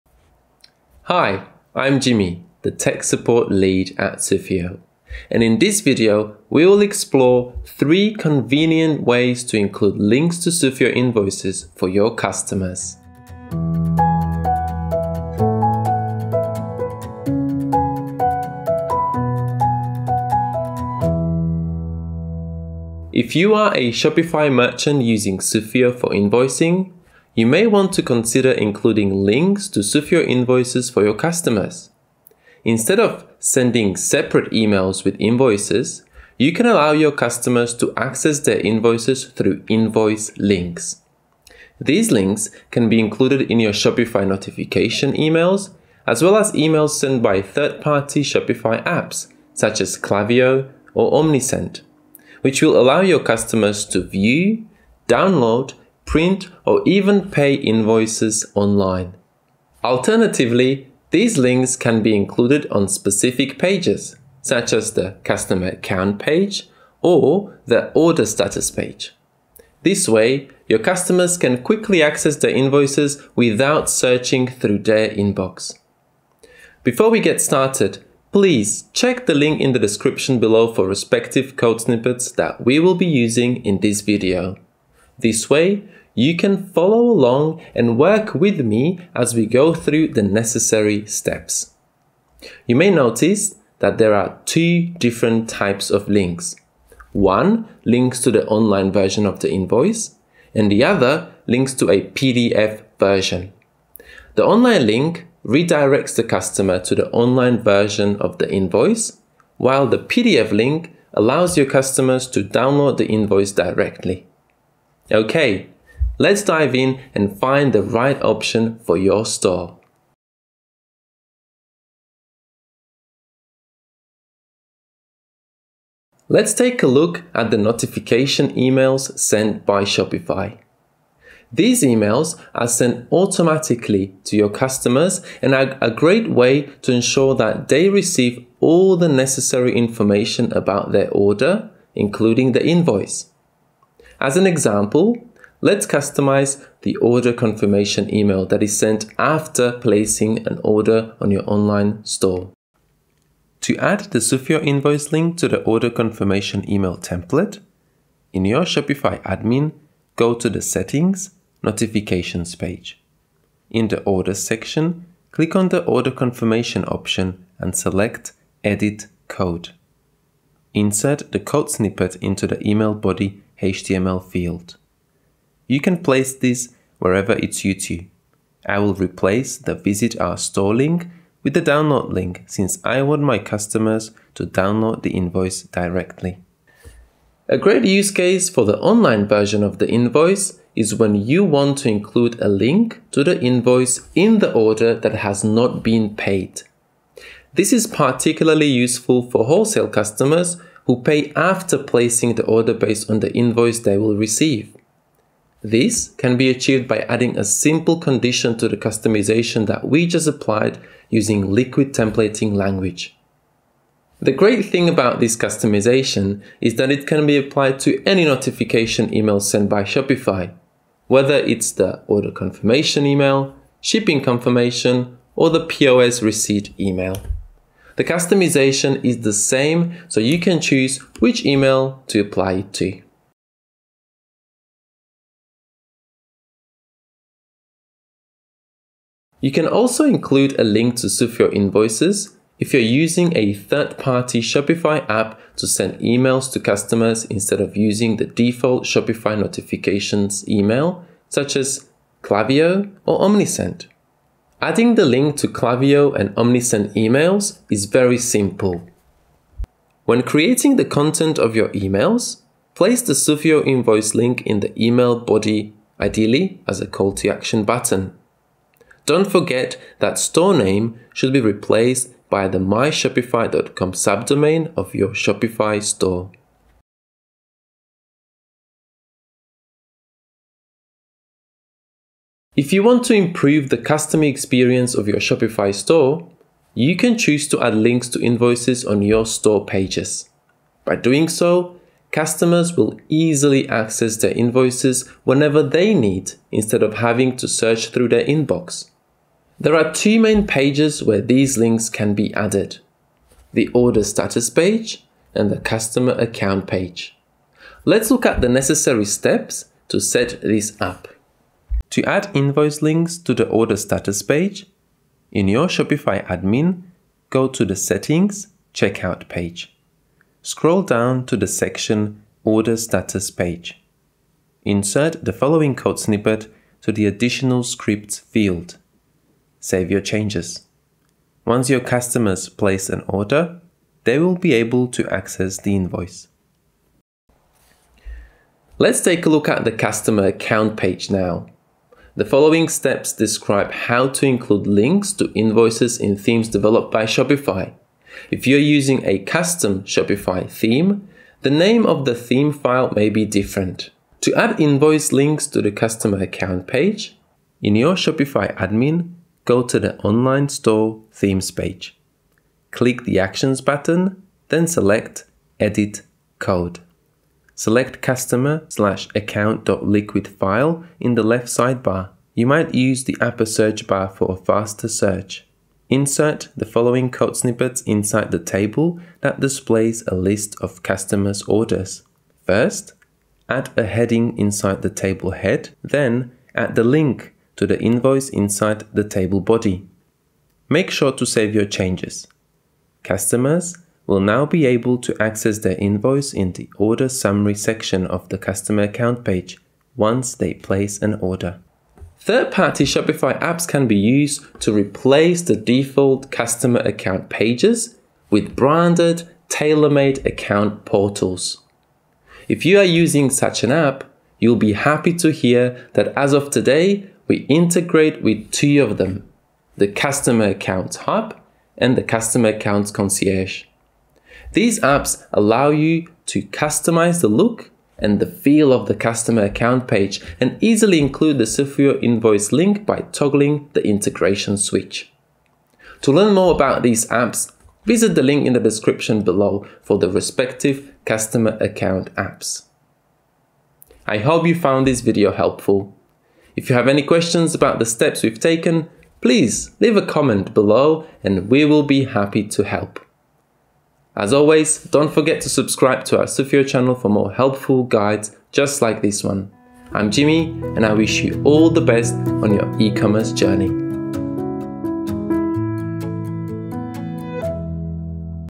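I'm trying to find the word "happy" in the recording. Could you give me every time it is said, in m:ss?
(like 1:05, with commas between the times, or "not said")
6:54, 7:32.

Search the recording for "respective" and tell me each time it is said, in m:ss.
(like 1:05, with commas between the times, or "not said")
1:20, 7:20.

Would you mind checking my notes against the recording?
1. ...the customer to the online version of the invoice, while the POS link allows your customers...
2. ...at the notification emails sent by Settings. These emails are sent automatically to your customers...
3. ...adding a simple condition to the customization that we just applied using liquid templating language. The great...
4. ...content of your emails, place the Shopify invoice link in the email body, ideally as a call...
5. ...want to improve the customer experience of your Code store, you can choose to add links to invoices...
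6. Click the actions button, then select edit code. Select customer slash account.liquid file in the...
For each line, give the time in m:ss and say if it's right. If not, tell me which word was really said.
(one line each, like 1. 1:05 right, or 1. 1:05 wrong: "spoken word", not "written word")
1. 1:46 wrong: "PDF", not "POS"
2. 2:07 wrong: "Shopify", not "Settings"
3. 3:27 right
4. 4:20 wrong: "Sufio", not "Shopify"
5. 4:42 wrong: "Shopify", not "Code"
6. 6:02 right.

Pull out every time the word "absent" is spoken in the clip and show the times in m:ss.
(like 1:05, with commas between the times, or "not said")
not said.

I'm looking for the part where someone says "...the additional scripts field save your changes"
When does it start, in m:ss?
5:26.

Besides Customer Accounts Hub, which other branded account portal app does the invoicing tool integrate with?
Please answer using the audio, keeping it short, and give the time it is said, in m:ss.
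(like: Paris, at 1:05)
Customer Accounts Concierge, at 7:02.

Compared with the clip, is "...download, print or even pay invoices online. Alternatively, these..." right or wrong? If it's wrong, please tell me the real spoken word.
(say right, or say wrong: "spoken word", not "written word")
right.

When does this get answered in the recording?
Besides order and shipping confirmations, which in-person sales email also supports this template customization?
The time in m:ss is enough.
3:45.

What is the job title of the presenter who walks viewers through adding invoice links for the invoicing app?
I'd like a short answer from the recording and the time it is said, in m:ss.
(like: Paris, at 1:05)
tech support lead, at 0:02.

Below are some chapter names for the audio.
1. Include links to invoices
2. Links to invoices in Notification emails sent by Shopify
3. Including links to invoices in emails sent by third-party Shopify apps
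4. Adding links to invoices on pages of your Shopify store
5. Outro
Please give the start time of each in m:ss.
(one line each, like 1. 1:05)
1. 0:17
2. 2:00
3. 3:53
4. 4:36
5. 7:23.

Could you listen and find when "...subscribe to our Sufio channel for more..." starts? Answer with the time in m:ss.
7:35.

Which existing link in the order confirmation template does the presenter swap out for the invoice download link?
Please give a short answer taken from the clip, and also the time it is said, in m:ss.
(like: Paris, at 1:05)
visit our store, at 2:59.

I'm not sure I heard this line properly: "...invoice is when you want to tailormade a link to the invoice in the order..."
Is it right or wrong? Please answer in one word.
wrong.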